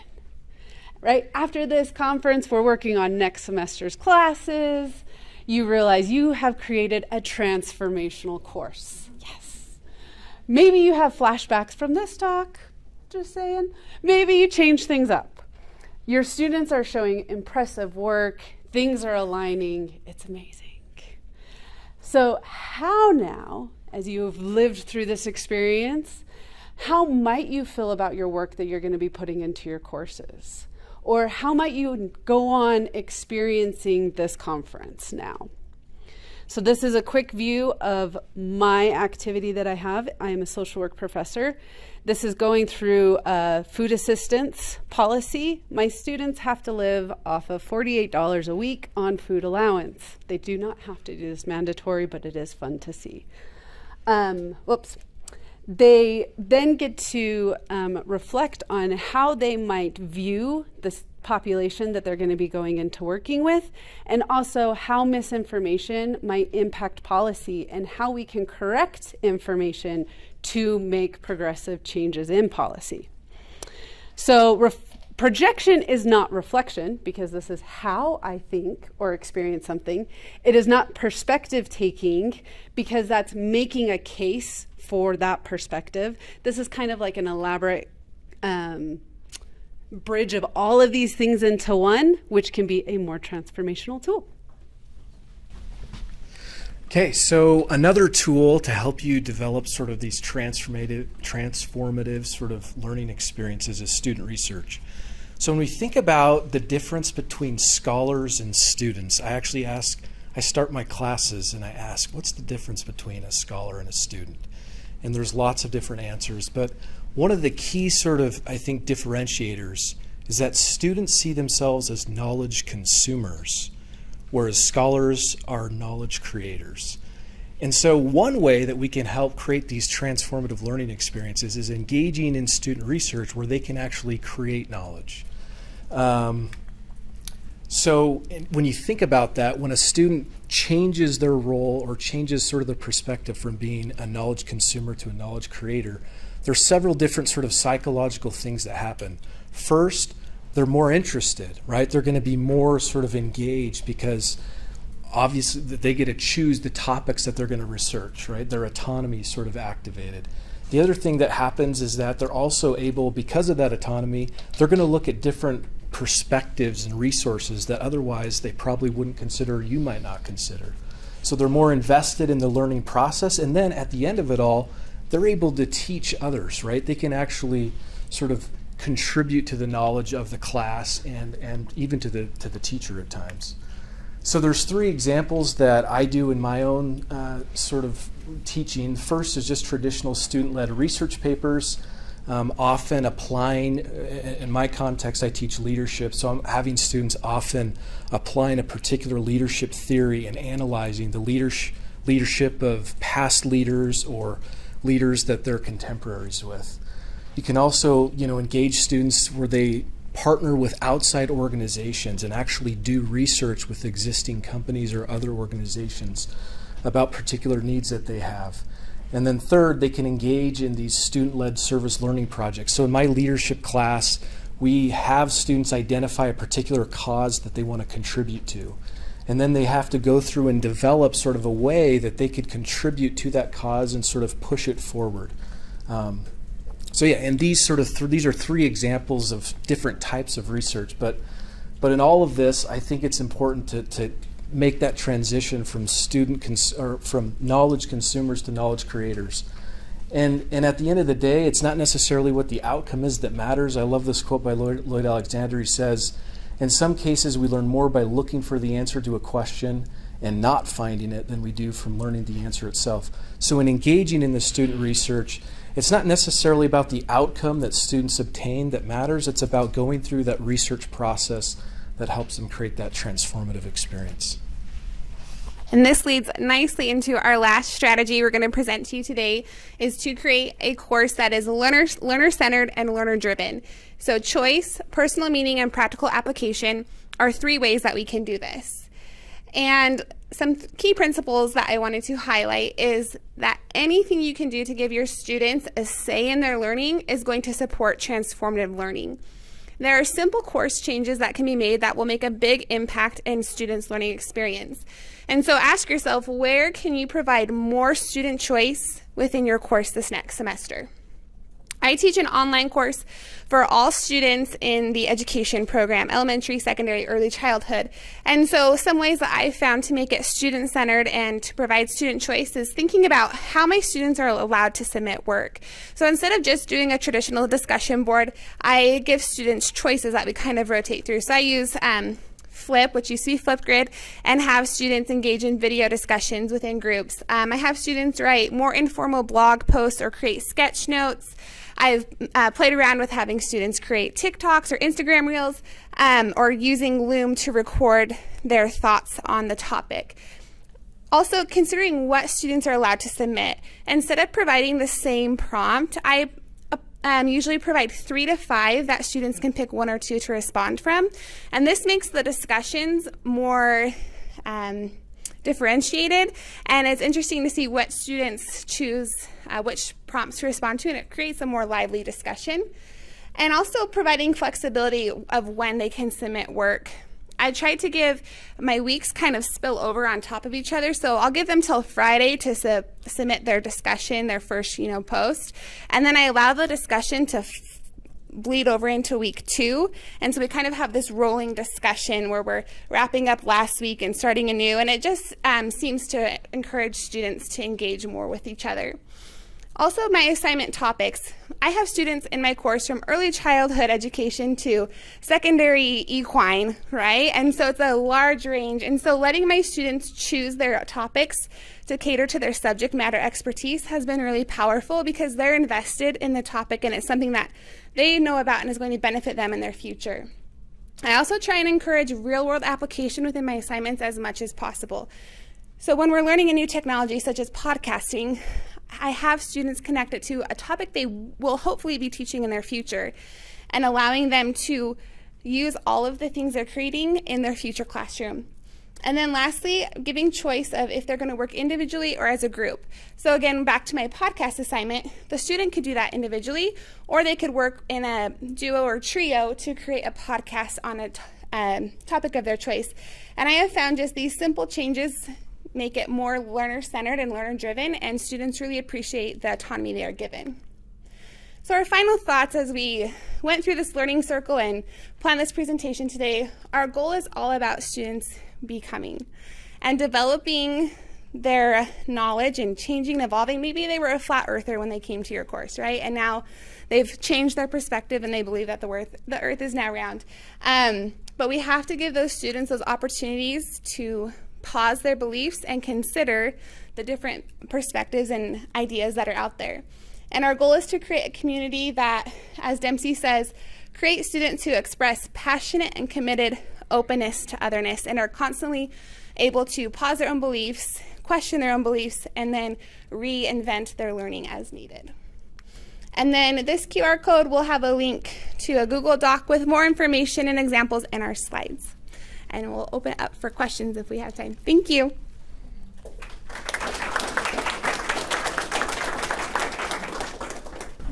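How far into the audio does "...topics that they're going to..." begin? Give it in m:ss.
2:36.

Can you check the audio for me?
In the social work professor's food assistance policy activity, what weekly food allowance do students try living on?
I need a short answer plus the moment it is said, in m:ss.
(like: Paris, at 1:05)
$48, at 0:47.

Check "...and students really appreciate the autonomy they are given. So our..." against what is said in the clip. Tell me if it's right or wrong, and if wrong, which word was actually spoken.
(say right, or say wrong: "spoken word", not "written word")
right.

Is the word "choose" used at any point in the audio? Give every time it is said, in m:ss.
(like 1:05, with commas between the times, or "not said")
2:36, 6:08, 6:50.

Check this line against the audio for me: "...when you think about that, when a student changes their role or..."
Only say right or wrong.
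right.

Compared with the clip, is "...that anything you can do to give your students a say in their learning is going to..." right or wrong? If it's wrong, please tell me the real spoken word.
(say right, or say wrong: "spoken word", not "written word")
right.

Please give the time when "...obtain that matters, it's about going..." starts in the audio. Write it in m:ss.
4:28.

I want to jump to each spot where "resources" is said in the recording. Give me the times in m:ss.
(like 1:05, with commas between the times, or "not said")
2:46.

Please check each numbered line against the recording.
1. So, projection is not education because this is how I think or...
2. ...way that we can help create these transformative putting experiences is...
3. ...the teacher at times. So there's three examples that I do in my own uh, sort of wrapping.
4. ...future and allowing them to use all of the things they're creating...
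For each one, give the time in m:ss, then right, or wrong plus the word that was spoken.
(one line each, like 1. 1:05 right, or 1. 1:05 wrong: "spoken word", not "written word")
1. 1:14 wrong: "reflection", not "education"
2. 2:08 wrong: "learning", not "putting"
3. 3:02 wrong: "teaching", not "wrapping"
4. 7:12 right.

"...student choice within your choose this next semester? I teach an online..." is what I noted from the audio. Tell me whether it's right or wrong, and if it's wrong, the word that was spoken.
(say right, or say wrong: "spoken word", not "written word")
wrong: "course", not "choose".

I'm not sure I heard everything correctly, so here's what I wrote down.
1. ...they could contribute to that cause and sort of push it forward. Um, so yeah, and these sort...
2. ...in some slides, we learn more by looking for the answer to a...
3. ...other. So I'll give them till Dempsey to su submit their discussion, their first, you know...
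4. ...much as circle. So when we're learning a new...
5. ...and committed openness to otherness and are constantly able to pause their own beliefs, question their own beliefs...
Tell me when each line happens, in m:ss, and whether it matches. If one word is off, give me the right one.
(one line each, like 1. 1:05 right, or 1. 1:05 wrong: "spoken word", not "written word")
1. 3:52 right
2. 4:16 wrong: "cases", not "slides"
3. 6:20 wrong: "Friday", not "Dempsey"
4. 7:04 wrong: "possible", not "circle"
5. 8:15 right.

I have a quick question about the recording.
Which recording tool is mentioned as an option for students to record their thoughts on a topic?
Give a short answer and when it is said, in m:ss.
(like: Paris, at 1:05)
Loom, at 5:47.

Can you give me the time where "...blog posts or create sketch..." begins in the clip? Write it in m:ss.
5:39.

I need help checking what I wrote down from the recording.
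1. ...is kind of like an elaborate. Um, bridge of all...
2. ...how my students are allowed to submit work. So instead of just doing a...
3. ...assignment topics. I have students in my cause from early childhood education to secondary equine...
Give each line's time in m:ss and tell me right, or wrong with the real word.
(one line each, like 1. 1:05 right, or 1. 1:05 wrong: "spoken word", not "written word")
1. 1:26 right
2. 5:23 right
3. 6:40 wrong: "course", not "cause".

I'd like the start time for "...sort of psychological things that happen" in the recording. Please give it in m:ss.
2:27.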